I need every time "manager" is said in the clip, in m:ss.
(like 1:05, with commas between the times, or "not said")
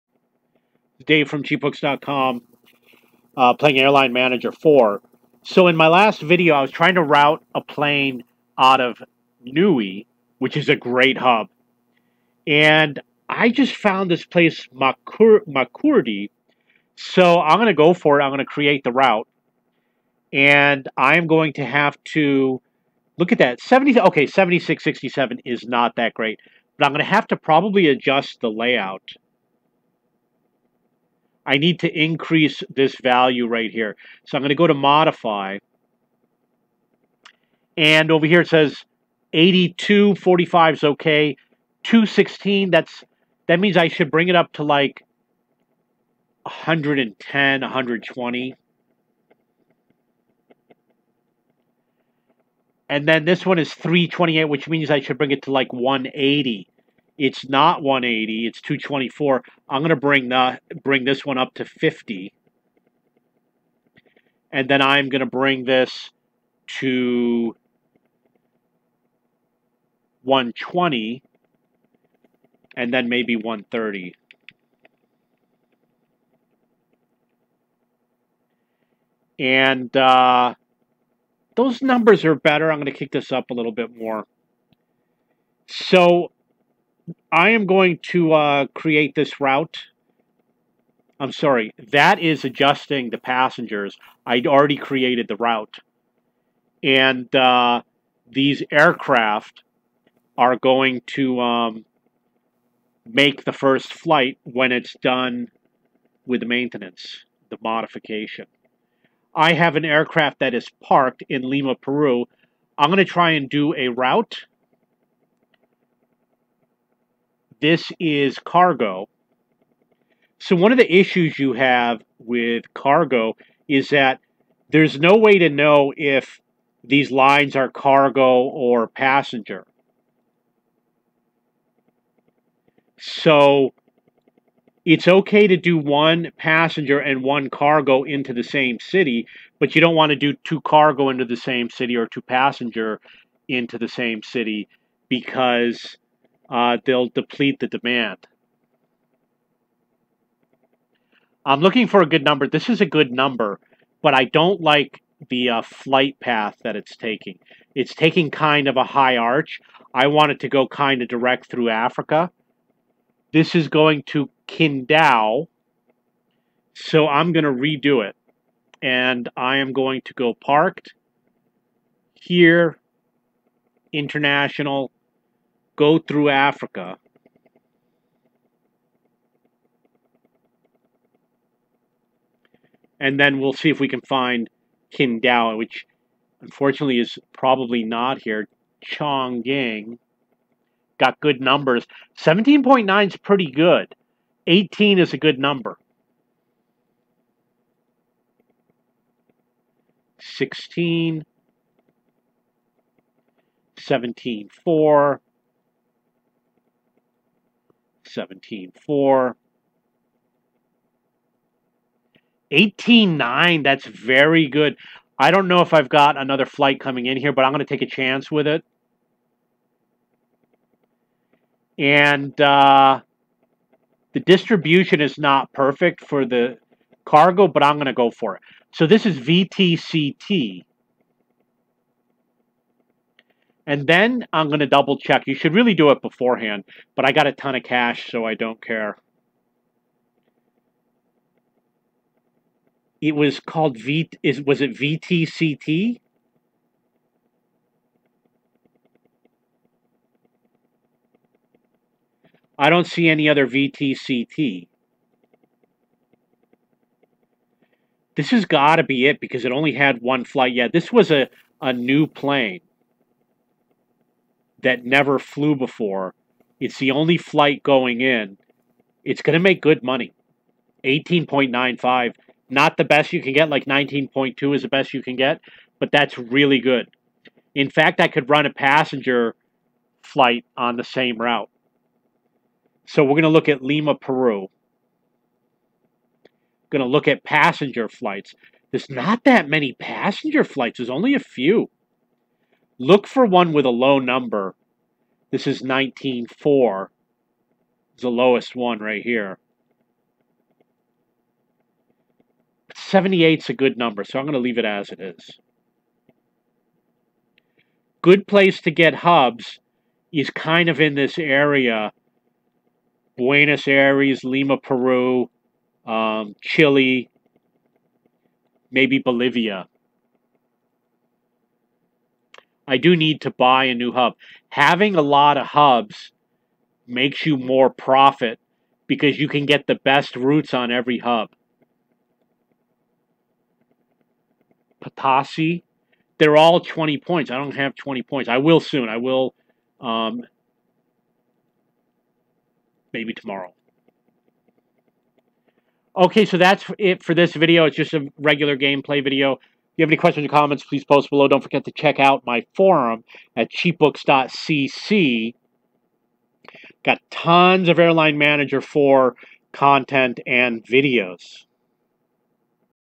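0:04, 5:58.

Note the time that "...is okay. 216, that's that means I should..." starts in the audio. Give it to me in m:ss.
0:40.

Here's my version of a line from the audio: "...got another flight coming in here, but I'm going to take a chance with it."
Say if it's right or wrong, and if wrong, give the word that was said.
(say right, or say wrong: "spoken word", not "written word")
right.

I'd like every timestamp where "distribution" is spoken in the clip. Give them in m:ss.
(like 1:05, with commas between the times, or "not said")
3:44.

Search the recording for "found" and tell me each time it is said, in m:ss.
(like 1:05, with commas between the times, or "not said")
0:13.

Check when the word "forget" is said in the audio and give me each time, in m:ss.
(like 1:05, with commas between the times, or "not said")
5:51.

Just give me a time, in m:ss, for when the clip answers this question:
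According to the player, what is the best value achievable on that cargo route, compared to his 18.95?
4:33.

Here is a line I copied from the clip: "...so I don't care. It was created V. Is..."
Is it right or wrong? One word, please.
wrong.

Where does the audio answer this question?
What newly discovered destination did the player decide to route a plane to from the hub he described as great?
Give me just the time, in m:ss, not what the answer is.
0:15.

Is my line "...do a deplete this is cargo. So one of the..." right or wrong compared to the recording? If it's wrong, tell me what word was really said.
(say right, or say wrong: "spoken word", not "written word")
wrong: "route", not "deplete".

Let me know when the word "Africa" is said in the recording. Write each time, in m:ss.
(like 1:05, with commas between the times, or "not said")
2:41, 2:56.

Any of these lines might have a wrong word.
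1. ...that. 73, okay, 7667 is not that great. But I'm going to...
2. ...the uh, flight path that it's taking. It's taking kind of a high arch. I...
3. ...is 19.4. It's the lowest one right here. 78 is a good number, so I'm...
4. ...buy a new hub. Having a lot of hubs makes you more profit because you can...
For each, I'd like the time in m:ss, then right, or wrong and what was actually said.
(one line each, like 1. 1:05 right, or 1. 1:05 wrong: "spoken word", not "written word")
1. 0:23 wrong: "70", not "73"
2. 2:35 right
3. 4:55 right
4. 5:23 right.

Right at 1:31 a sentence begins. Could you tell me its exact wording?
I'm sorry, that is adjusting the passengers.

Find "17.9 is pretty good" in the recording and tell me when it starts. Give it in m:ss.
3:12.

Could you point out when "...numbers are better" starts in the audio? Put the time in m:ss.
1:21.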